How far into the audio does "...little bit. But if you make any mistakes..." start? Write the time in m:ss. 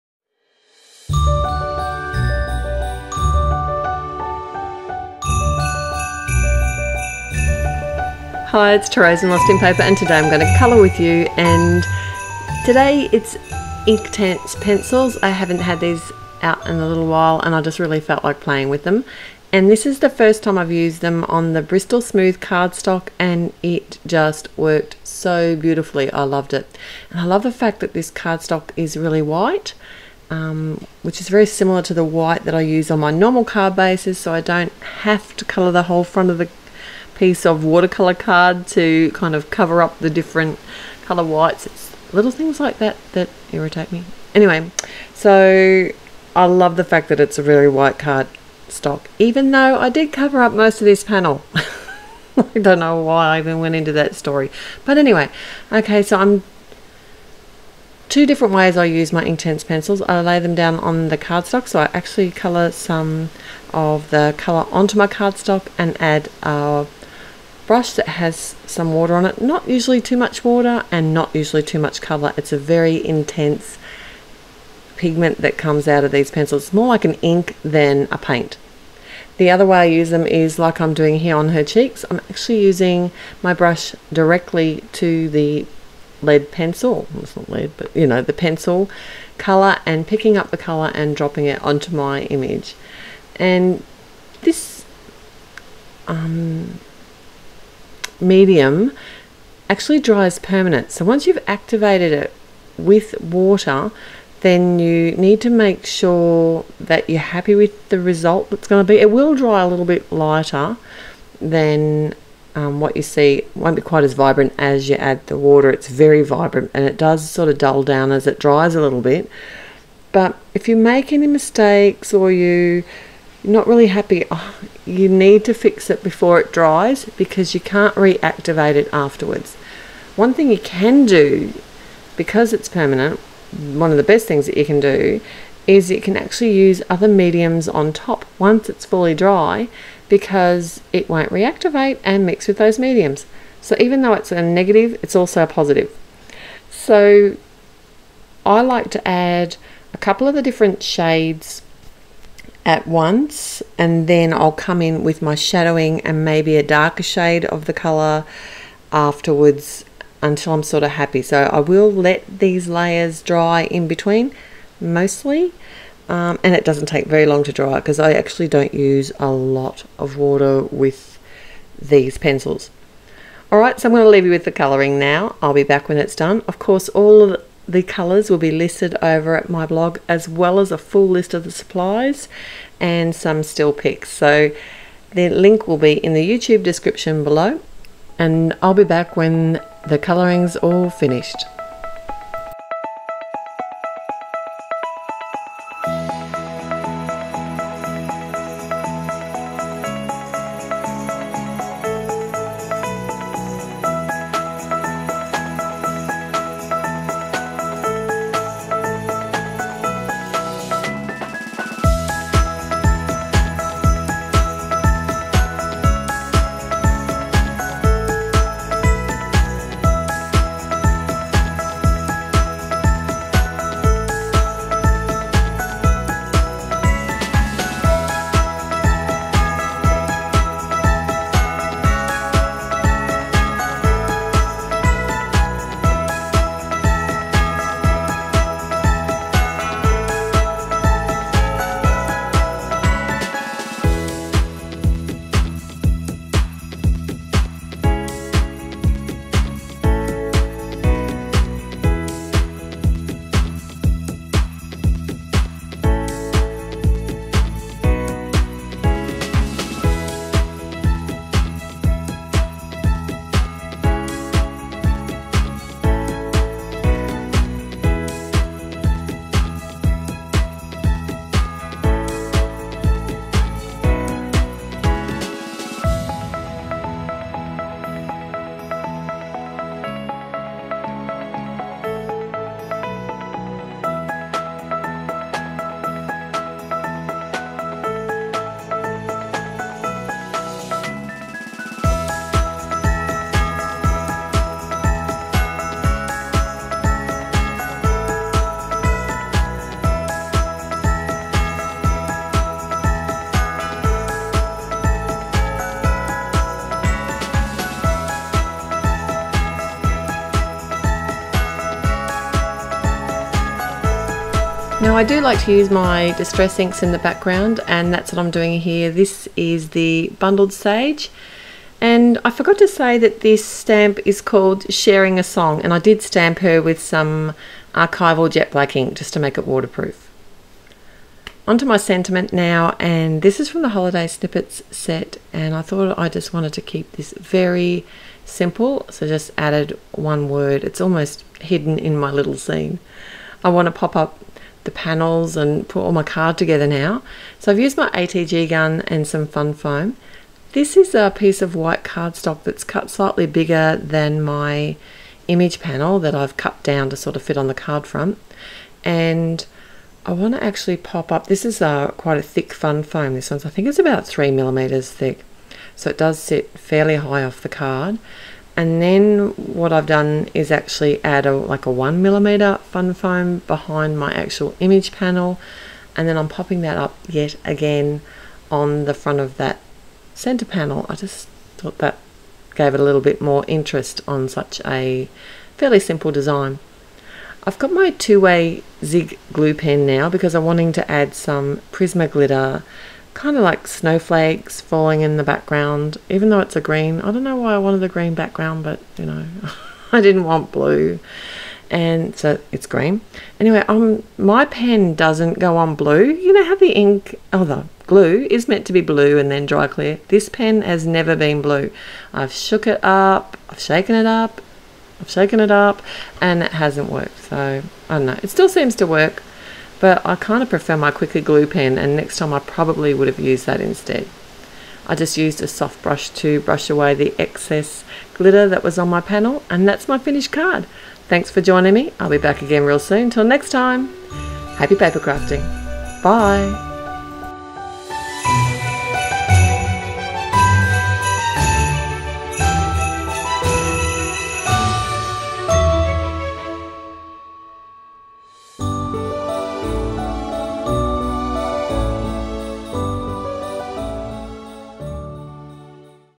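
1:58.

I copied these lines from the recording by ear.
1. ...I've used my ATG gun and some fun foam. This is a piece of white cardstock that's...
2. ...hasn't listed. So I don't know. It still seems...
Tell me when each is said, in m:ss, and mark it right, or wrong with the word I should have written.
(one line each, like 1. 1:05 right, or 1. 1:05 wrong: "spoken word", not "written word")
1. 5:47 right
2. 6:56 wrong: "worked", not "listed".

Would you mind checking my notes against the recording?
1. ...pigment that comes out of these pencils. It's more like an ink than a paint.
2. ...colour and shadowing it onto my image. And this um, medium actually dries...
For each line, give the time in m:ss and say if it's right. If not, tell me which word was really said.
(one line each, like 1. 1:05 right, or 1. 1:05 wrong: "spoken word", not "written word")
1. 1:14 right
2. 1:30 wrong: "dropping", not "shadowing".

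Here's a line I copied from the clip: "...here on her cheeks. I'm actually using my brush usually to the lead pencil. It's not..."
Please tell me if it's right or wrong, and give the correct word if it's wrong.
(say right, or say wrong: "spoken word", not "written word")
wrong: "directly", not "usually".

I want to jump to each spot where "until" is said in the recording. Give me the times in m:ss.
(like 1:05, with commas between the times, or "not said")
2:40.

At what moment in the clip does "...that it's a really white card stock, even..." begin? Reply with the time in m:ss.
0:47.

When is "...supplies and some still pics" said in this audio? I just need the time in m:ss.
3:01.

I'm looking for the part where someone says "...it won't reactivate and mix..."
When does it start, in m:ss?
2:20.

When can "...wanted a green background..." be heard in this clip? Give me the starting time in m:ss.
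6:37.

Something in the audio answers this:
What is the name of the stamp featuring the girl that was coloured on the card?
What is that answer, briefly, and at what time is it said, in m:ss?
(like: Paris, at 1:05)
Sharing a Song, at 5:24.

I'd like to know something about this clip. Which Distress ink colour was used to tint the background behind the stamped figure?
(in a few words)
Bundled Sage.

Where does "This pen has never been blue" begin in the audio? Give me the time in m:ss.
6:50.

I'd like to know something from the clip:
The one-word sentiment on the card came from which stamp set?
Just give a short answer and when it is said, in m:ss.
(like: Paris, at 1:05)
Holiday Snippets, at 5:33.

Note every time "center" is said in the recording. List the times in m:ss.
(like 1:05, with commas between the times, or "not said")
6:20.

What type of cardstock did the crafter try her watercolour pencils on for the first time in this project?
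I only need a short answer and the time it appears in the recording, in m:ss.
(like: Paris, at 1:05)
Bristol Smooth, at 0:21.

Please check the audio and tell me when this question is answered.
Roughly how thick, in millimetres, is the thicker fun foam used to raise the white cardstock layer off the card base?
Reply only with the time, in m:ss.
6:04.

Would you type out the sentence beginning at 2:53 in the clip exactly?
Alright, so I'm going to leave you with the colouring now.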